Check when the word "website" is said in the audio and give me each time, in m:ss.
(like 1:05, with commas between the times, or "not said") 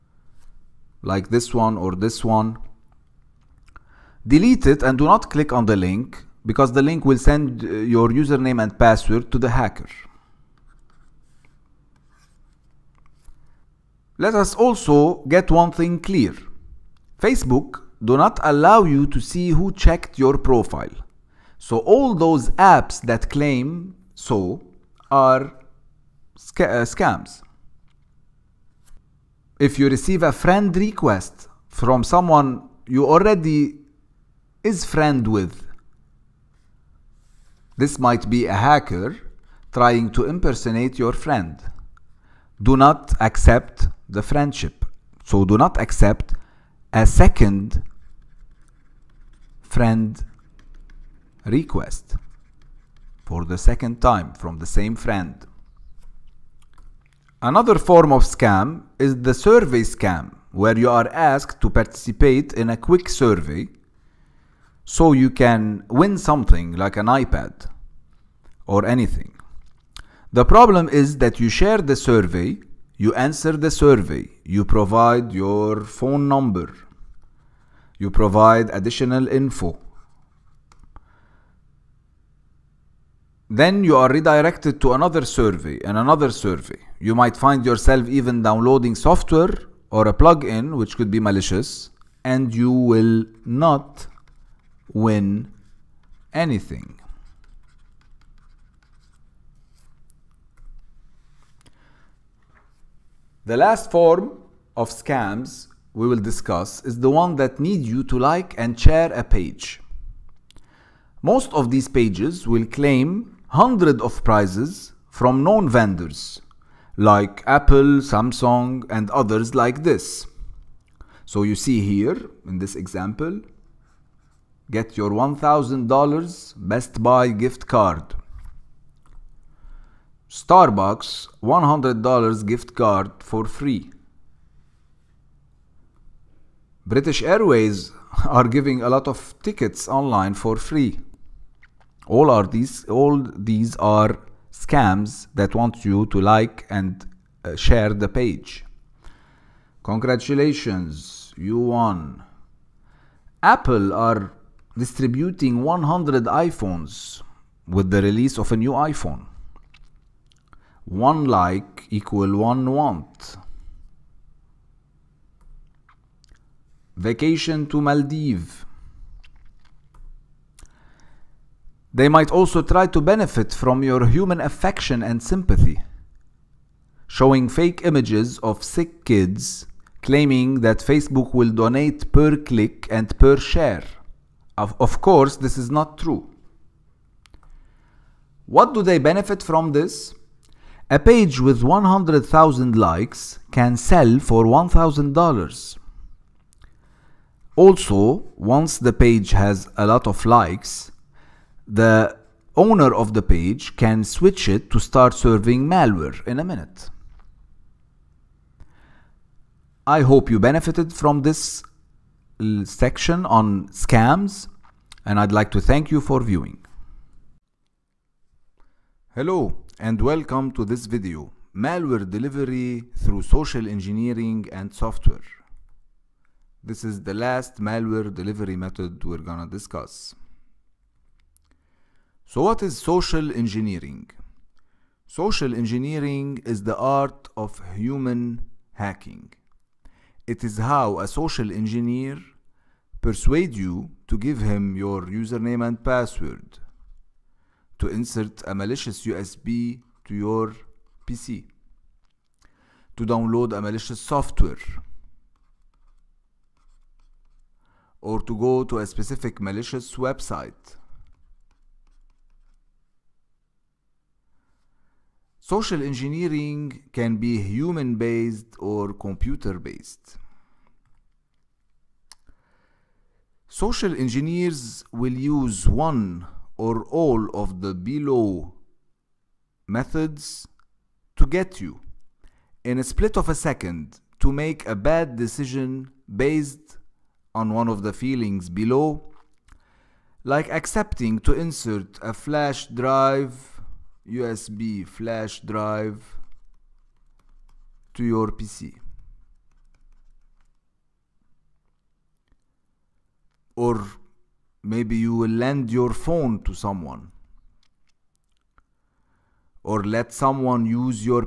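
4:19.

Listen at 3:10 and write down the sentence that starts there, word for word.
A page with 100,000 likes can sell for $1,000.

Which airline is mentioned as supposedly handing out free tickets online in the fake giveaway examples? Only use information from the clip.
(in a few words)
British Airways.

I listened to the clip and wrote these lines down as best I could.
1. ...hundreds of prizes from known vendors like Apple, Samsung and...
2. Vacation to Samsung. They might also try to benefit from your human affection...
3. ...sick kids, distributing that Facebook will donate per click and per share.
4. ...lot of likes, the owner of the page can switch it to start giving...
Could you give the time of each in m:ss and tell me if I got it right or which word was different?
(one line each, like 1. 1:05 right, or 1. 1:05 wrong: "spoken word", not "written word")
1. 1:53 right
2. 2:46 wrong: "Maldives", not "Samsung"
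3. 2:58 wrong: "claiming", not "distributing"
4. 3:19 wrong: "serving", not "giving".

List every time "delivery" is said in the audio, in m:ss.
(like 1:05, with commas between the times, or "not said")
3:42, 3:48.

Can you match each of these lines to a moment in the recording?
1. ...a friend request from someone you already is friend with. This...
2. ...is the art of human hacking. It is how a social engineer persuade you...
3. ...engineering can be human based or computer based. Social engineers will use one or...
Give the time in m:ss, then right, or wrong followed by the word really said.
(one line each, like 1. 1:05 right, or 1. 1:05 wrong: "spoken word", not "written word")
1. 0:30 right
2. 3:56 right
3. 4:25 right.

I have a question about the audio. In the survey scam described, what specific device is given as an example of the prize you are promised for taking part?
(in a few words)
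iPad.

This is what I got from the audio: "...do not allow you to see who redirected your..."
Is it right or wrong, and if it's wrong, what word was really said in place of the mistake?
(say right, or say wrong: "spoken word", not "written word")
wrong: "checked", not "redirected".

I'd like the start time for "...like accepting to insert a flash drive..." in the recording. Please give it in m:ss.
4:50.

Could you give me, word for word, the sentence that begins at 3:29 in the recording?
I hope you benefited from this section on scams and I'd like to thank you for viewing.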